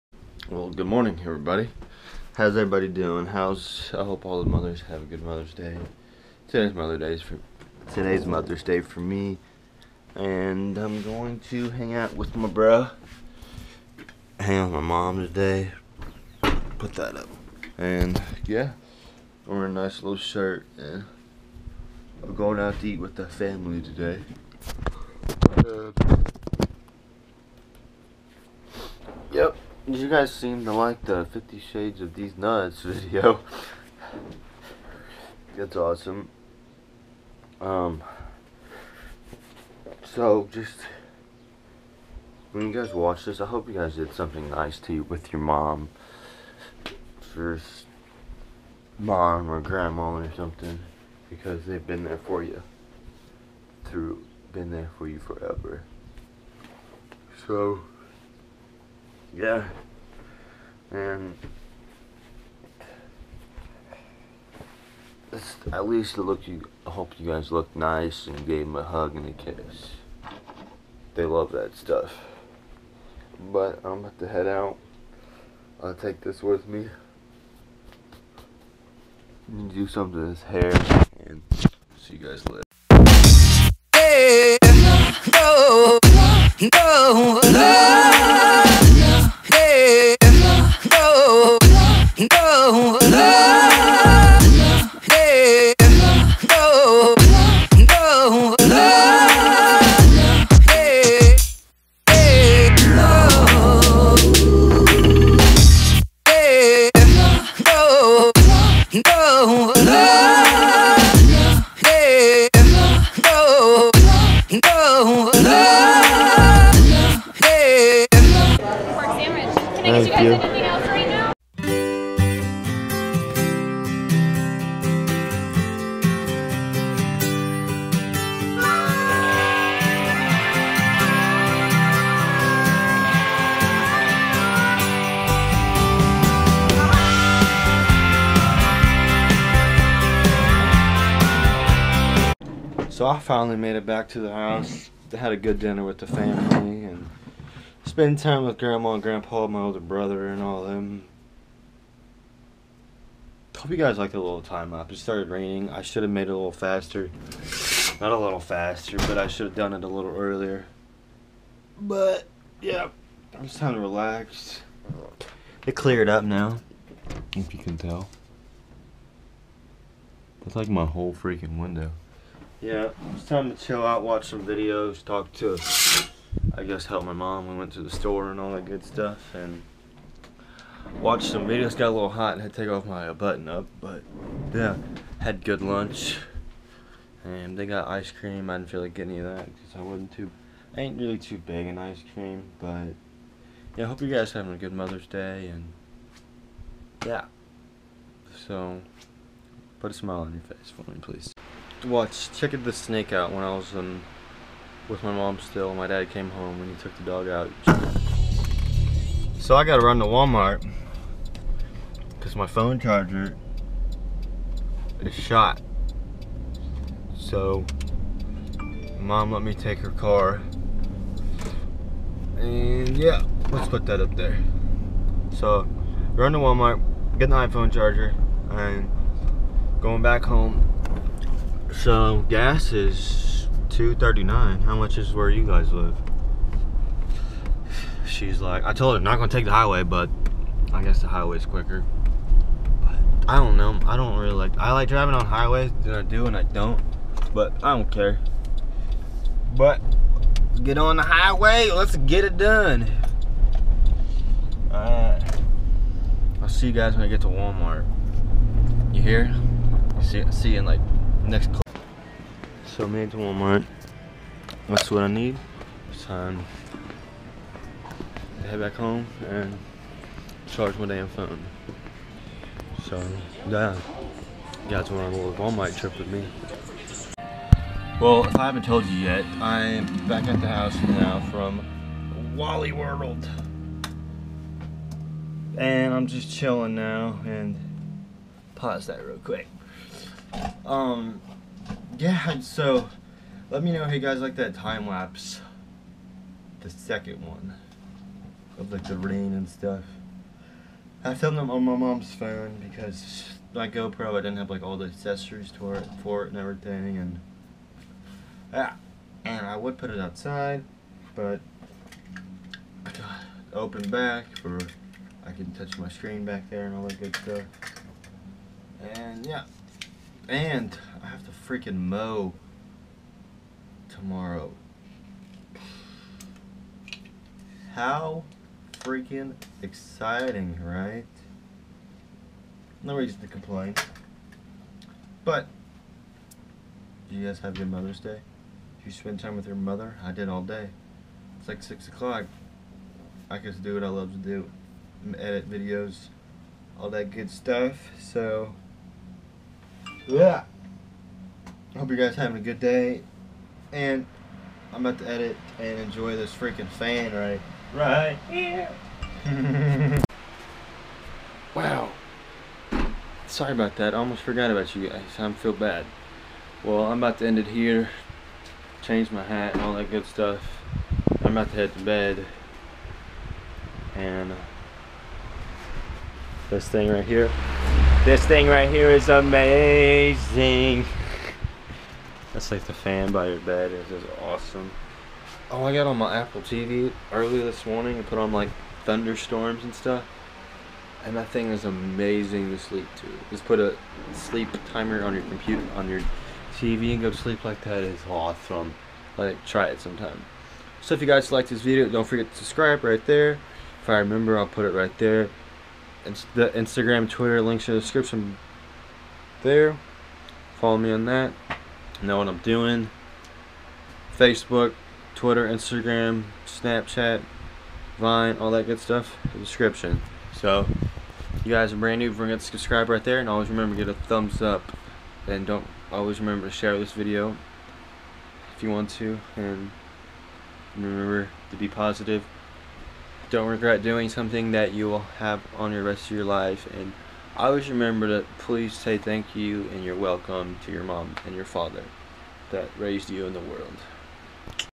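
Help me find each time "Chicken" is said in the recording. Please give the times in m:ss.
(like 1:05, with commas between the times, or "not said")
3:22.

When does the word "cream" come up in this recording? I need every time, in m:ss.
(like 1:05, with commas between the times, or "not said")
3:08, 3:12.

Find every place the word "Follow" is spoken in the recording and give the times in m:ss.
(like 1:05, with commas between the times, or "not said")
6:50.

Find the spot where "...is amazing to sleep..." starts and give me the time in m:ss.
6:31.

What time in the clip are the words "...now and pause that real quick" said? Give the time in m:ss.
4:46.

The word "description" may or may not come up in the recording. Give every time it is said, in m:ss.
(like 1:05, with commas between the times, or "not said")
6:47, 6:59.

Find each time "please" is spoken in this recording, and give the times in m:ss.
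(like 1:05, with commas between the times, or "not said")
3:21, 7:18.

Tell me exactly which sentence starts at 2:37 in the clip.
Not a little faster, but I should have done it a little earlier.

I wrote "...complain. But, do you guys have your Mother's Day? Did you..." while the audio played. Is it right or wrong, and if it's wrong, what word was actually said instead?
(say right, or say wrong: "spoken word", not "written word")
right.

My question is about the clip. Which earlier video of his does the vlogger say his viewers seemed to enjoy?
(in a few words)
Fifty Shades of These Nuts.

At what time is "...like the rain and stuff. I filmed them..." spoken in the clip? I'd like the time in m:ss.
4:58.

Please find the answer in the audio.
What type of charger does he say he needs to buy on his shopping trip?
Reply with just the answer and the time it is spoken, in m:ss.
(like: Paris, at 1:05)
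iPhone charger, at 3:47.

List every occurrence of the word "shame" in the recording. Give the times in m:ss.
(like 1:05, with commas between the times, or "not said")
not said.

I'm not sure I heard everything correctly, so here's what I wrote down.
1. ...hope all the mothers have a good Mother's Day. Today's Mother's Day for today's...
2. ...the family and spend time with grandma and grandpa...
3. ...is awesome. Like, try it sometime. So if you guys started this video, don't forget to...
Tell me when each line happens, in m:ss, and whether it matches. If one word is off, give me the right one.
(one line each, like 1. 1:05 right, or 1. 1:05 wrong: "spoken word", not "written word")
1. 0:04 right
2. 2:25 right
3. 6:37 wrong: "liked", not "started".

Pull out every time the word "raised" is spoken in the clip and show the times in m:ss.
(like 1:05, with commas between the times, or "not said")
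7:22.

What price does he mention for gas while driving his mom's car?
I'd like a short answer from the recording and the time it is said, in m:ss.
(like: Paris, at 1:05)
2.39, at 3:53.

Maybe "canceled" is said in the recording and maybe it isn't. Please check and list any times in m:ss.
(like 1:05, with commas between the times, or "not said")
not said.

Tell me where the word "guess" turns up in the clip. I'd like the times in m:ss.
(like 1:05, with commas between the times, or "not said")
2:56, 4:00.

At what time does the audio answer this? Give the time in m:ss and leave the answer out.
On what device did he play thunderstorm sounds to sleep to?
6:26.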